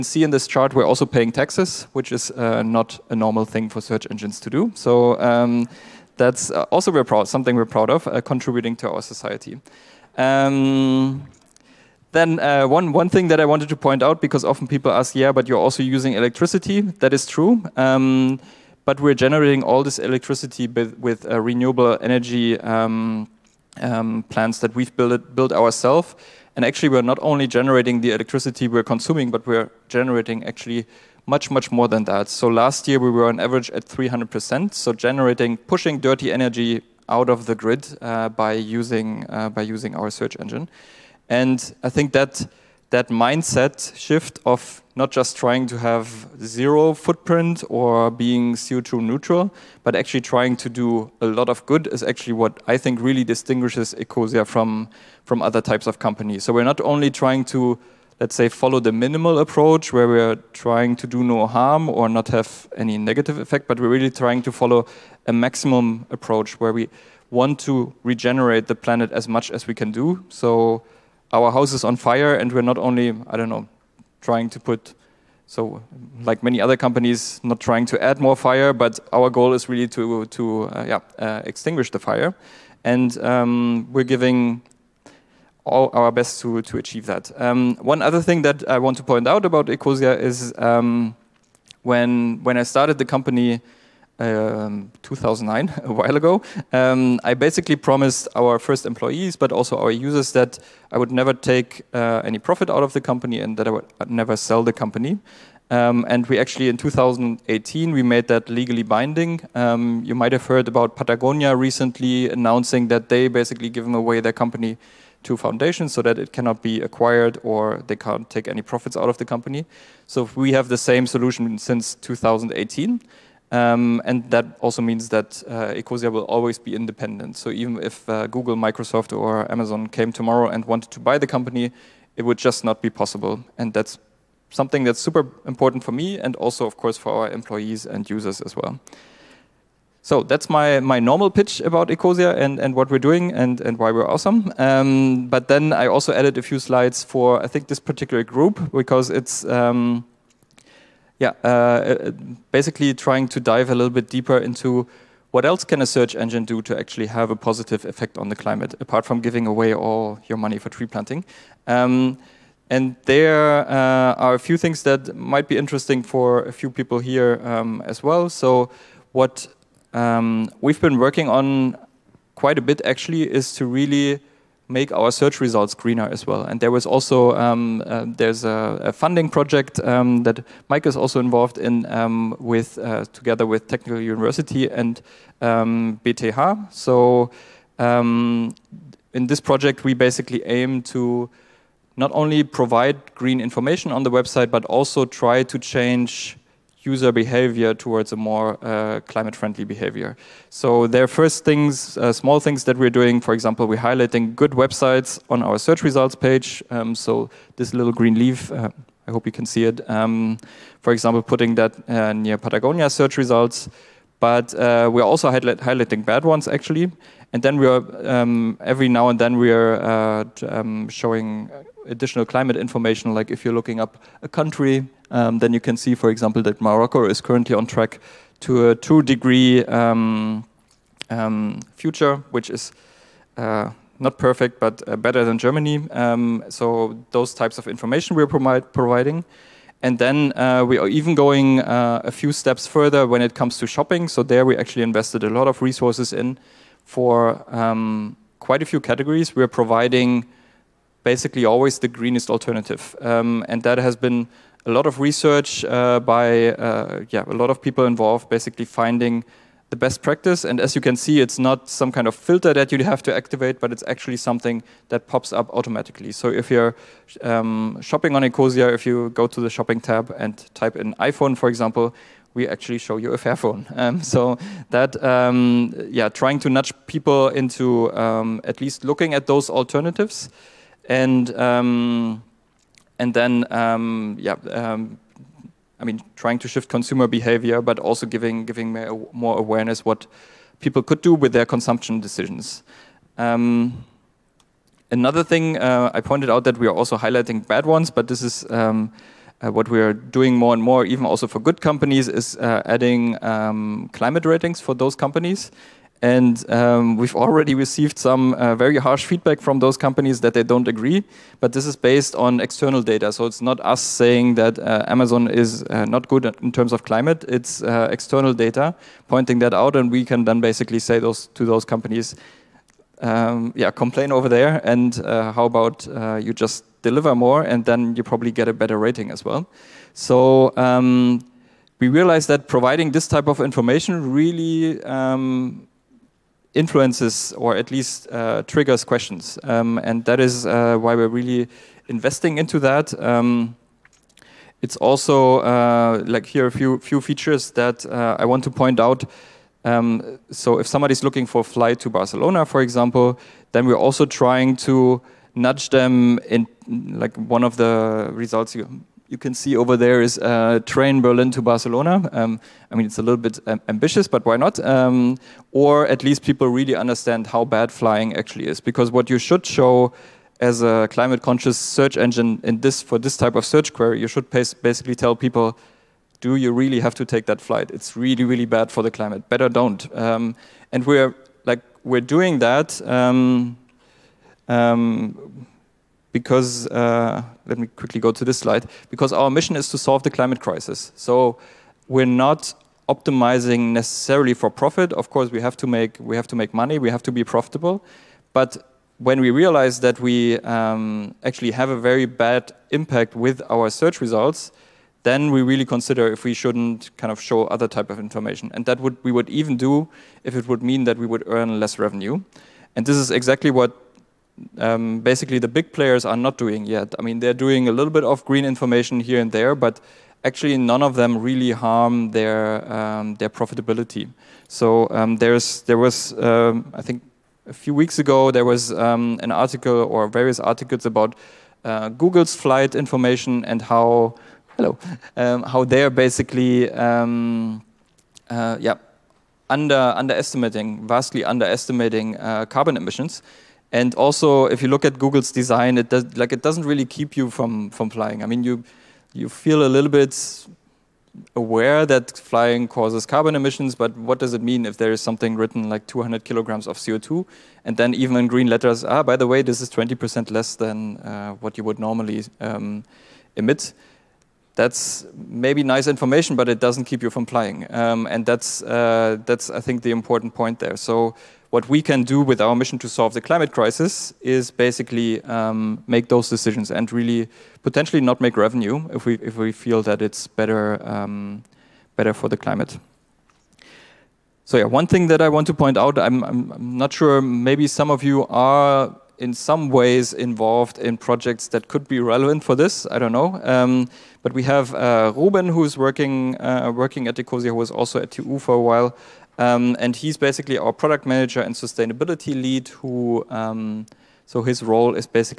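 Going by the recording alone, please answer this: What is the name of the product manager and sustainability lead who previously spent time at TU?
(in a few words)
Ruben.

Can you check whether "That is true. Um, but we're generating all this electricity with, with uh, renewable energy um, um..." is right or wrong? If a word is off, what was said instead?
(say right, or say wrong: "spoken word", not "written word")
right.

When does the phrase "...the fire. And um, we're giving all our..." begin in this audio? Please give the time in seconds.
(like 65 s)
81 s.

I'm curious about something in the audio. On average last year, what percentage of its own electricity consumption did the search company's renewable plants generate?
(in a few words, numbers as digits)
300%.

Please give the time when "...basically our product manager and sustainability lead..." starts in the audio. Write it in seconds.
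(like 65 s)
500 s.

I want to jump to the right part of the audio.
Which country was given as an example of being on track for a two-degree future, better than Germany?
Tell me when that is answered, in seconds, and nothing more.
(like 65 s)
226 s.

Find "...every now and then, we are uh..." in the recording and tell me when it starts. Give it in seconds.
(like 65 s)
218 s.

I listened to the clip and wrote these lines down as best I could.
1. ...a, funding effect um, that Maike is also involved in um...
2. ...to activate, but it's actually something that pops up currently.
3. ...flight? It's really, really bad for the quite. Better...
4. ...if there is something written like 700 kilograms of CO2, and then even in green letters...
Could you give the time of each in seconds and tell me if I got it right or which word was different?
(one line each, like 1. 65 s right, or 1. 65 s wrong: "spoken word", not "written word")
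1. 178 s wrong: "project", not "effect"
2. 263 s wrong: "automatically", not "currently"
3. 377 s wrong: "climate", not "quite"
4. 454 s wrong: "200", not "700".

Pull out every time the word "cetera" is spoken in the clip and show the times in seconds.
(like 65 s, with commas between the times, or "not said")
not said.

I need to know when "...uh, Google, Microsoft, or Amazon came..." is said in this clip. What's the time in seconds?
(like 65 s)
128 s.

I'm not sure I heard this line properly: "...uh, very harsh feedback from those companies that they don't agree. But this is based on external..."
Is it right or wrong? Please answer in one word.
right.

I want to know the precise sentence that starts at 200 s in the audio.
So there are first things, uh, small things that we're doing.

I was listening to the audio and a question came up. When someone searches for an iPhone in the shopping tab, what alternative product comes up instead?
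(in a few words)
Fairphone.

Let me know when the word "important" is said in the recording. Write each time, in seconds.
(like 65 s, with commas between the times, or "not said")
135 s, 469 s.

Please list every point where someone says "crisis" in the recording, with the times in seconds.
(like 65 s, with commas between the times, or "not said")
390 s, 473 s.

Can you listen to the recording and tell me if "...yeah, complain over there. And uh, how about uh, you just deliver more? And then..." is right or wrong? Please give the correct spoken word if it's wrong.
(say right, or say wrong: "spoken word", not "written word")
right.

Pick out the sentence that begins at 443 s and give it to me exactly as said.
And also, if you look at Google's design, it does, like it doesn't really keep you from from flying.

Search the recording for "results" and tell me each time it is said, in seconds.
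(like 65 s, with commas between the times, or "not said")
175 s, 205 s, 213 s, 358 s, 404 s.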